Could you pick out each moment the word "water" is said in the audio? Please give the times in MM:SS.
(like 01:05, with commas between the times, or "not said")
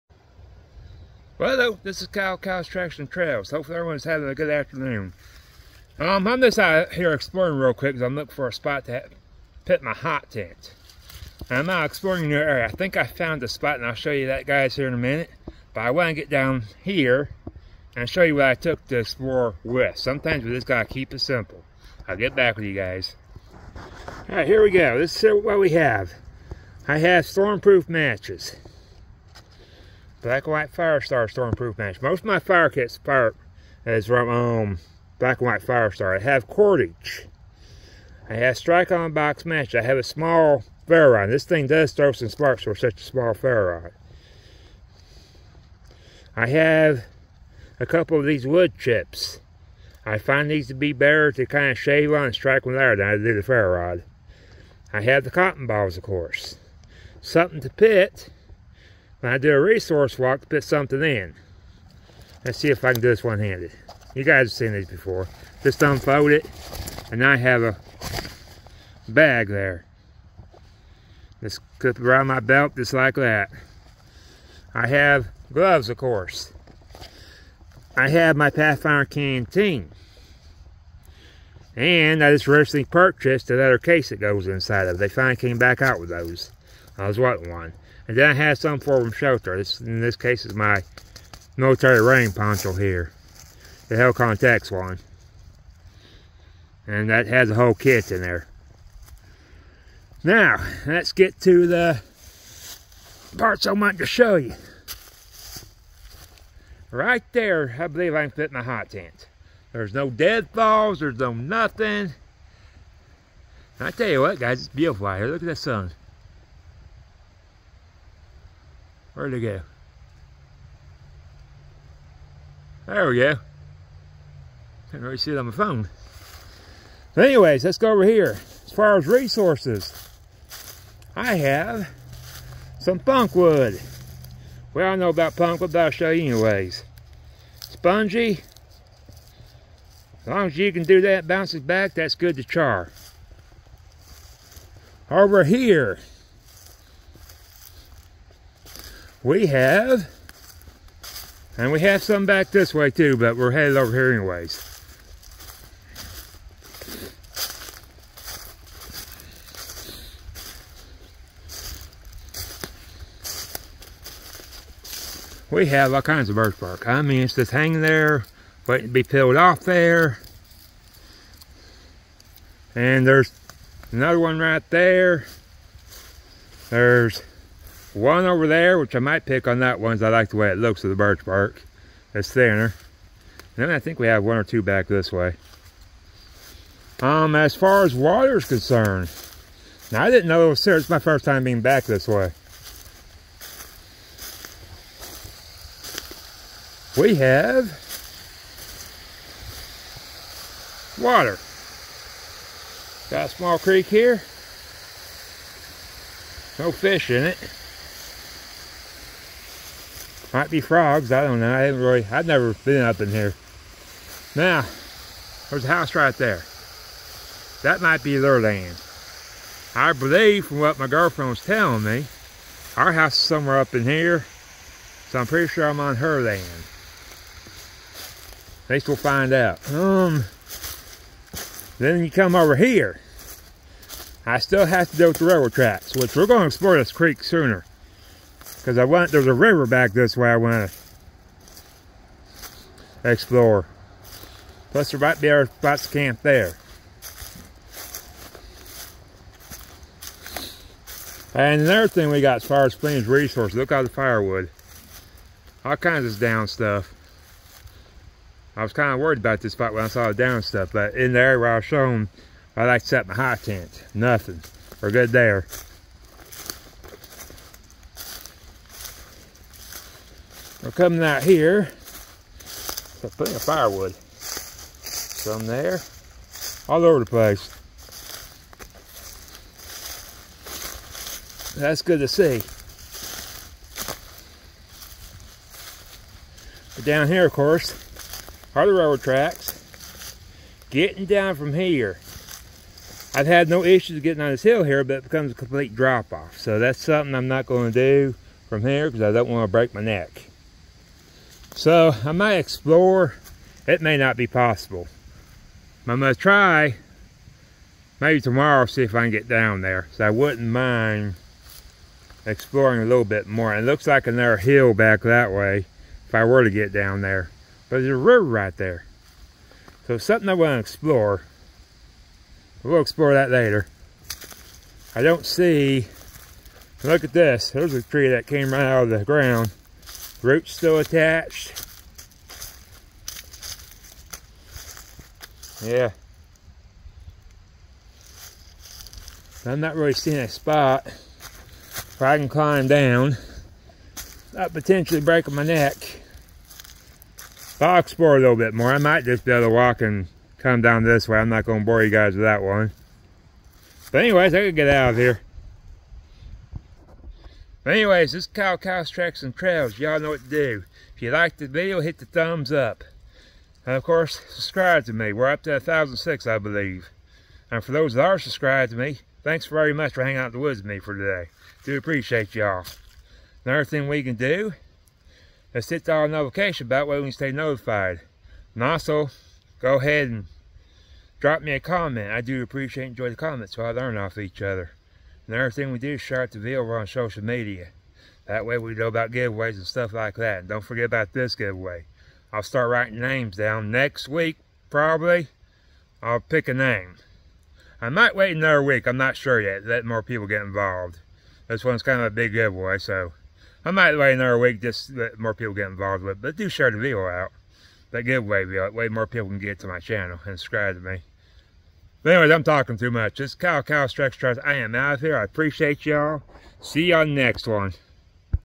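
03:07, 03:21.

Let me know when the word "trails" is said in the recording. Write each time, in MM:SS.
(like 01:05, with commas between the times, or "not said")
00:03, 05:59.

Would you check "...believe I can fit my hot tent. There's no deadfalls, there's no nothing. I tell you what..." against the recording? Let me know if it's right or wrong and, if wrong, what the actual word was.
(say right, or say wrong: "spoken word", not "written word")
right.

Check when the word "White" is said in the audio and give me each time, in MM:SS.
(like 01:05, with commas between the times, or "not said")
00:30, 00:35.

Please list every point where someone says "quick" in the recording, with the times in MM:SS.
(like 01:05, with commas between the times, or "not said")
00:07.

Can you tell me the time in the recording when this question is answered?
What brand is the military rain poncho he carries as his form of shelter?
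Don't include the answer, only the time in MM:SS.
01:33.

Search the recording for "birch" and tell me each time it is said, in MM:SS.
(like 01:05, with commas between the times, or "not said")
02:46, 03:00.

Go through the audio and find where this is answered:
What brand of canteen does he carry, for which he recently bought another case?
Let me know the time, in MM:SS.
01:18.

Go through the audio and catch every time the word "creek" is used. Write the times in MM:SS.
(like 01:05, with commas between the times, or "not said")
03:23, 03:56.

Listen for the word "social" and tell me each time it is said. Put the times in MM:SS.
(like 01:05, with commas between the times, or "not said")
06:26.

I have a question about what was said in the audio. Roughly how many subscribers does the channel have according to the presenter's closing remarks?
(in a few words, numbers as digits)
1,006.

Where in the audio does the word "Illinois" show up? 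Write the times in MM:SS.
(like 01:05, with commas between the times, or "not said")
not said.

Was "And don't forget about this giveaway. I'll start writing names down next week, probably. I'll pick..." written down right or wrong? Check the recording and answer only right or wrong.
right.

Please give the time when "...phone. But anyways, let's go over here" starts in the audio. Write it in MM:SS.
02:05.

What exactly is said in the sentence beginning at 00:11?
And I'm out exploring new area.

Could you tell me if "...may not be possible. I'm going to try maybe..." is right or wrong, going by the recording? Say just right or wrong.
right.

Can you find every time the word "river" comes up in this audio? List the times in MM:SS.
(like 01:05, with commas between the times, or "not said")
03:59, 05:17.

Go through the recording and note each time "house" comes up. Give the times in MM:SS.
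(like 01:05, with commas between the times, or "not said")
03:35, 03:42.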